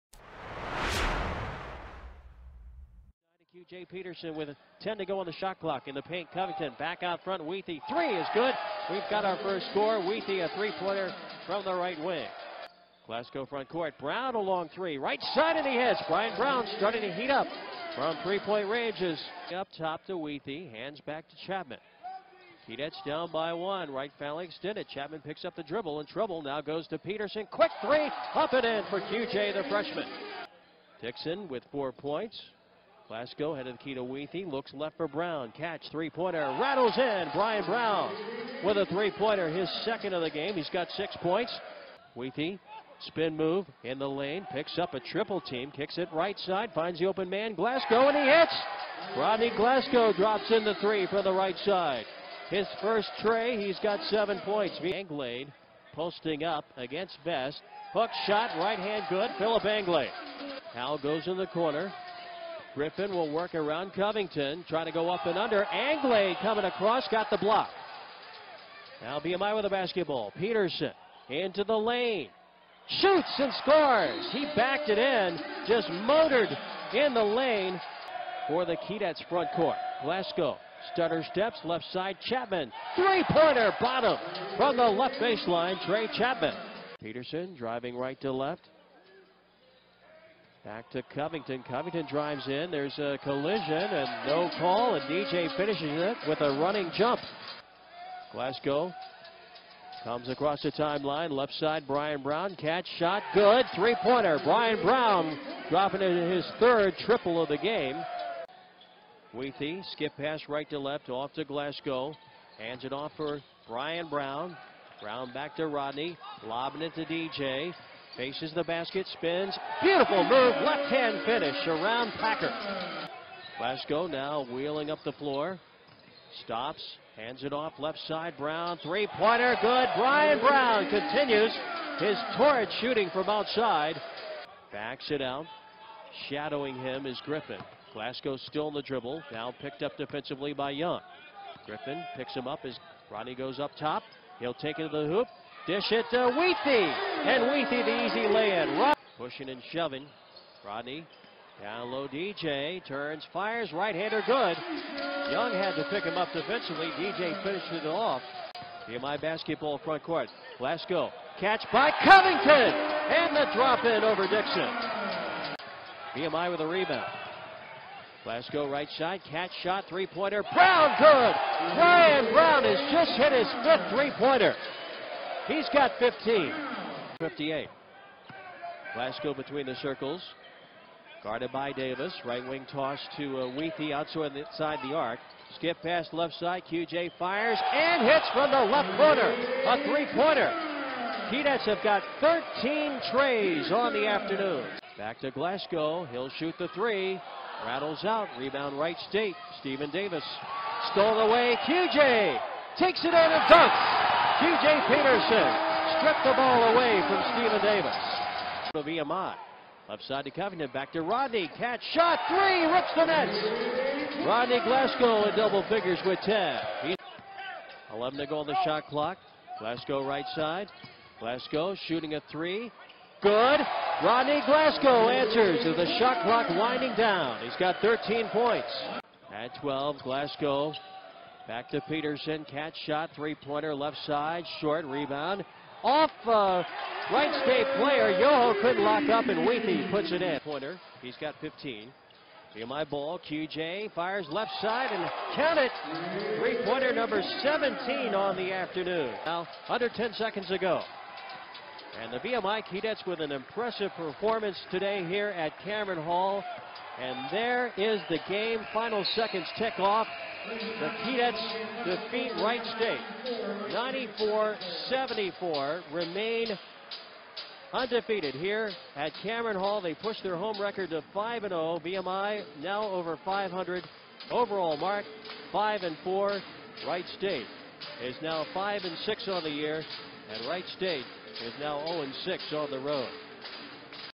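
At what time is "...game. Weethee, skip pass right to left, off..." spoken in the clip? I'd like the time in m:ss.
1:47.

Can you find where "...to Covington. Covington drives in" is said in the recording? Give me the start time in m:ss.
1:30.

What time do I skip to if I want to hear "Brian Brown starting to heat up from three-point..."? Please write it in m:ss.
0:16.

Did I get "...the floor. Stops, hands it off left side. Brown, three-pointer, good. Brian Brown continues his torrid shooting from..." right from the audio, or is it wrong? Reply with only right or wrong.
right.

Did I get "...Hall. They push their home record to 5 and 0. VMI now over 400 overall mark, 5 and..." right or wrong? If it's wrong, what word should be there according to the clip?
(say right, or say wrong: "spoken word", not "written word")
wrong: "500", not "400".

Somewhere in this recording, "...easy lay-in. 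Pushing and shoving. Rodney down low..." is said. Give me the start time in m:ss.
2:28.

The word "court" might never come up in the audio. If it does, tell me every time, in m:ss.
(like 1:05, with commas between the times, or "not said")
0:13, 1:19, 2:40.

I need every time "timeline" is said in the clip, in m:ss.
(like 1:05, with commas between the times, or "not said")
1:40.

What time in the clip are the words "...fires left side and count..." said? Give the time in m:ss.
4:03.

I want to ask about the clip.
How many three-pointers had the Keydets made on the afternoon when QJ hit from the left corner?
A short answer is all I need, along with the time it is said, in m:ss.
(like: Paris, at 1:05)
13, at 3:12.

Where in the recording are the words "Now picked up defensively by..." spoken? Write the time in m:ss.
2:19.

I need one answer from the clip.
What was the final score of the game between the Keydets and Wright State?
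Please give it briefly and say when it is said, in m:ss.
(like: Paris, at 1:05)
94-74, at 4:23.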